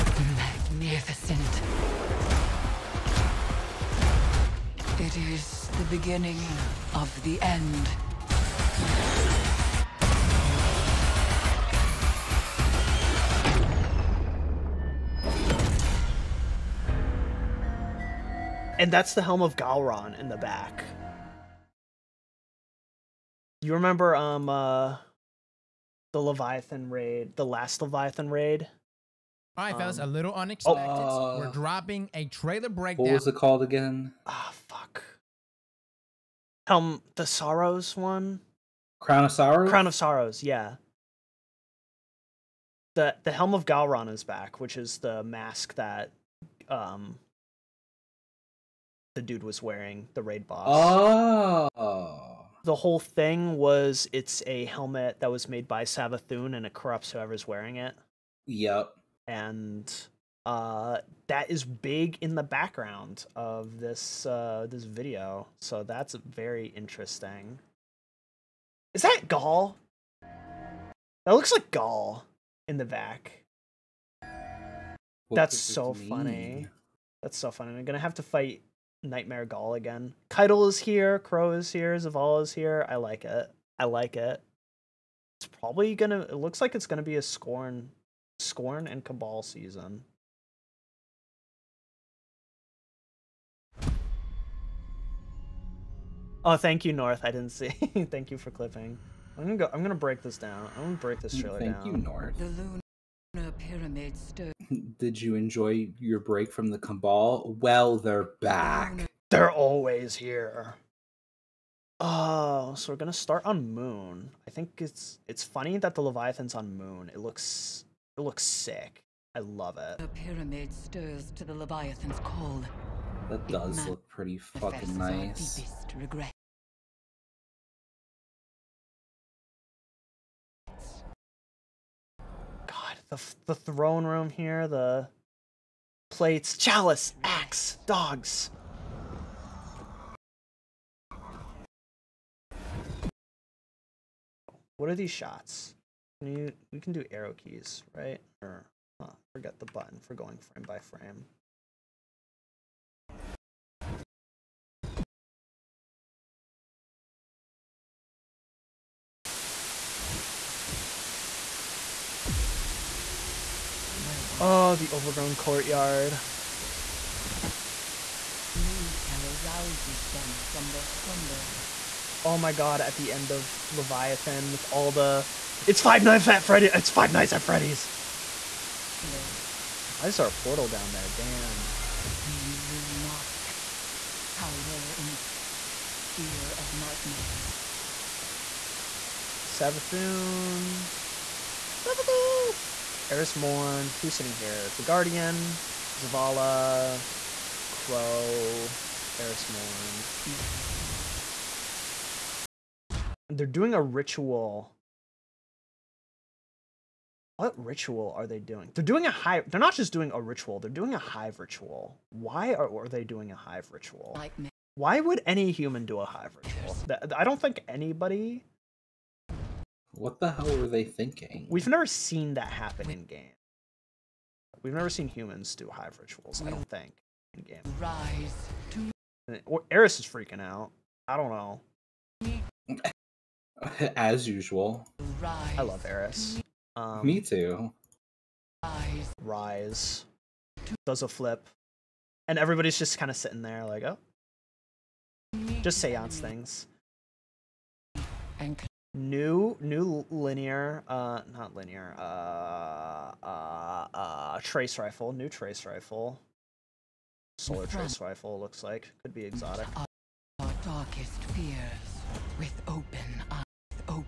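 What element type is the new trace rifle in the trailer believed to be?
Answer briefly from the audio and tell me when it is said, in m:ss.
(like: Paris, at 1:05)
Solar, at 4:17.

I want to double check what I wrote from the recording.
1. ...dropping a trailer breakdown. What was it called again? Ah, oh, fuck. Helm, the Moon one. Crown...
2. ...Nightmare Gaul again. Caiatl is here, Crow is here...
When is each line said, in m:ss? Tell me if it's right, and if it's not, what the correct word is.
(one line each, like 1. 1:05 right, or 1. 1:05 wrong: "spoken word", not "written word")
1. 0:31 wrong: "Sorrows", not "Moon"
2. 1:19 right.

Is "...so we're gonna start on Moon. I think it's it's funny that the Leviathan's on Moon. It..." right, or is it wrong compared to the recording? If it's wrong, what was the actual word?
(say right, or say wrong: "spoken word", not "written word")
right.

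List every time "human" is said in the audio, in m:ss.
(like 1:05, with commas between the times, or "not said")
3:35, 3:45.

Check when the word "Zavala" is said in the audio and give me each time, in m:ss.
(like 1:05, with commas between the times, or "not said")
1:21, 3:15.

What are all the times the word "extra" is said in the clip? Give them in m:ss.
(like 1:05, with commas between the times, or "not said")
not said.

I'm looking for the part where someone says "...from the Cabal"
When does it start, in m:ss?
1:46.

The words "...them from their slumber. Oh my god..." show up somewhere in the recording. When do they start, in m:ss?
2:50.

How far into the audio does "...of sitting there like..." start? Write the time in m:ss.
4:03.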